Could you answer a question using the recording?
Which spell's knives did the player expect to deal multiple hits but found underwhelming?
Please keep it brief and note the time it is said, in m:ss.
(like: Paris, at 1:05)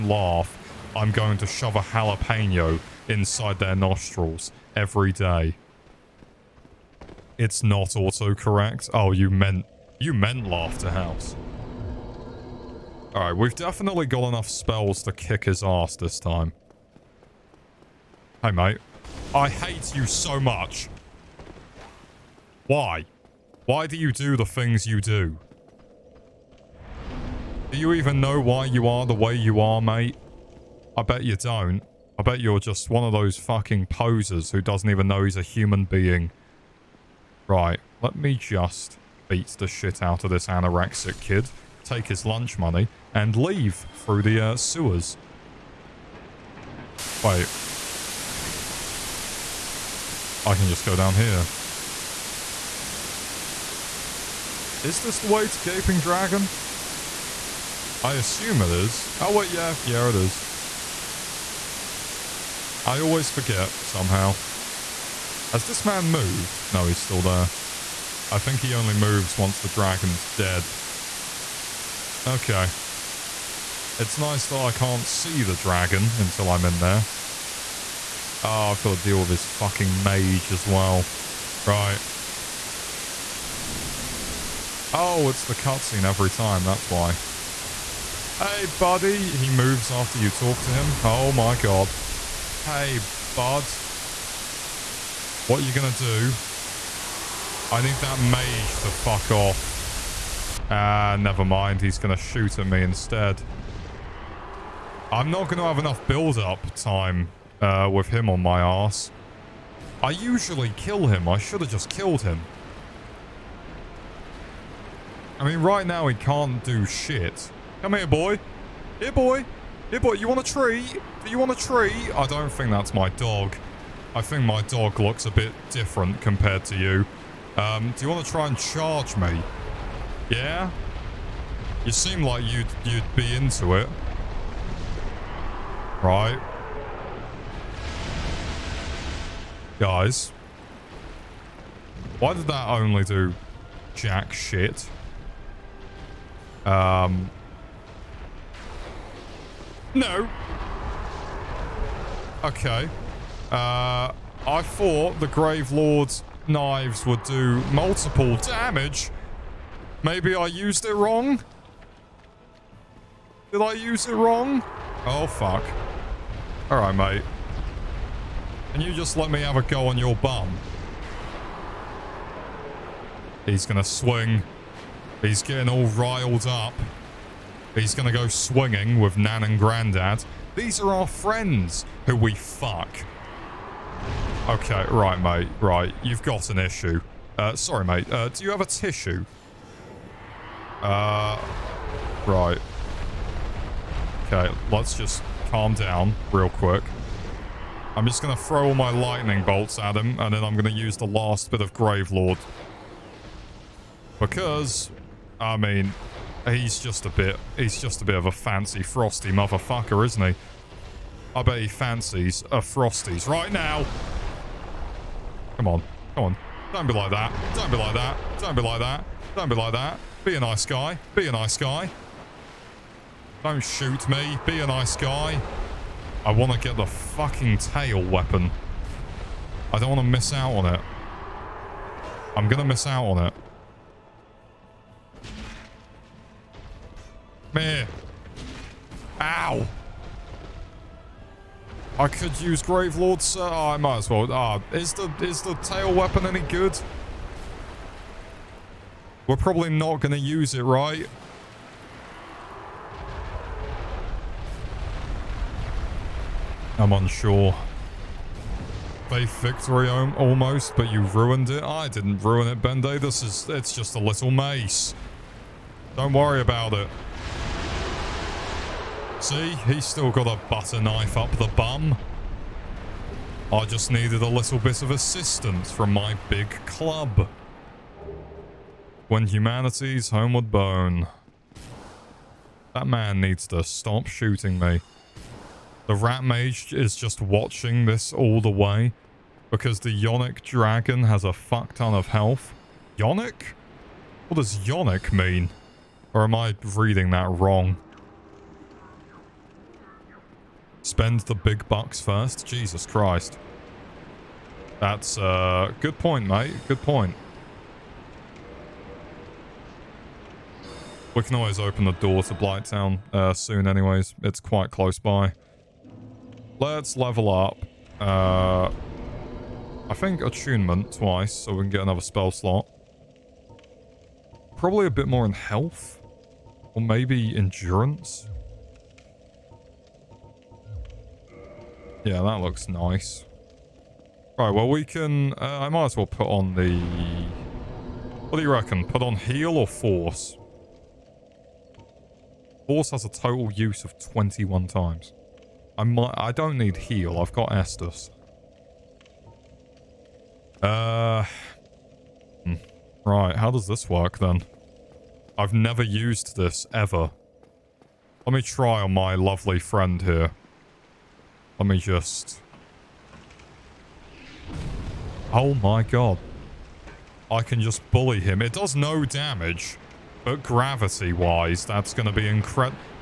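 Grave Lords knives, at 2:35.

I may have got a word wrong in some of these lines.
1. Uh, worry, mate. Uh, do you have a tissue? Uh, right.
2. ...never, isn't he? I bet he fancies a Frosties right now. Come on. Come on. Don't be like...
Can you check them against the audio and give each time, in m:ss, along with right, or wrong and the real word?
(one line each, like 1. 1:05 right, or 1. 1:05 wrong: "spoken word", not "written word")
1. 3:07 wrong: "sorry", not "worry"
2. 3:29 wrong: "motherfucker", not "never".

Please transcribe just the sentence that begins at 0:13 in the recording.
Alright, we've definitely got enough spells to kick his ass this time.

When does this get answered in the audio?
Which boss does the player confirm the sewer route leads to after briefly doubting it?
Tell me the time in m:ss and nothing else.
0:55.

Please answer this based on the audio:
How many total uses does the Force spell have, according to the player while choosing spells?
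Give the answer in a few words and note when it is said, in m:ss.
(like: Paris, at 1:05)
21, at 5:43.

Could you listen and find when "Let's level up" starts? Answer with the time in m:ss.
5:16.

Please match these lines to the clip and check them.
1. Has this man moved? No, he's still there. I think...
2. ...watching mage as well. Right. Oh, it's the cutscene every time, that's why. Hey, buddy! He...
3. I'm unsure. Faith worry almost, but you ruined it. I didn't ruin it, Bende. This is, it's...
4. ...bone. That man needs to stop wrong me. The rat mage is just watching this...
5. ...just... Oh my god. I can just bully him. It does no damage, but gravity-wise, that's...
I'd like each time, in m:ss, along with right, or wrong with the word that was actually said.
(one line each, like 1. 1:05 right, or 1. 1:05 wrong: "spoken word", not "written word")
1. 1:05 right
2. 1:19 wrong: "fucking", not "watching"
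3. 4:16 wrong: "victory", not "worry"
4. 4:40 wrong: "shooting", not "wrong"
5. 6:01 right.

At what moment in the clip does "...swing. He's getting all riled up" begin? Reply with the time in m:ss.
2:53.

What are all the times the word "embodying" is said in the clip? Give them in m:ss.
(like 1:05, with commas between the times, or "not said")
not said.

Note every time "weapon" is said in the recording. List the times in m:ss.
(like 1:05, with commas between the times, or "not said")
3:48, 4:05.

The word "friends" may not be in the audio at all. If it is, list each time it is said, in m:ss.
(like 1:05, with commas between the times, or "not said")
3:01, 5:59.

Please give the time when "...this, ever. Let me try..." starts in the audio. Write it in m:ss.
5:56.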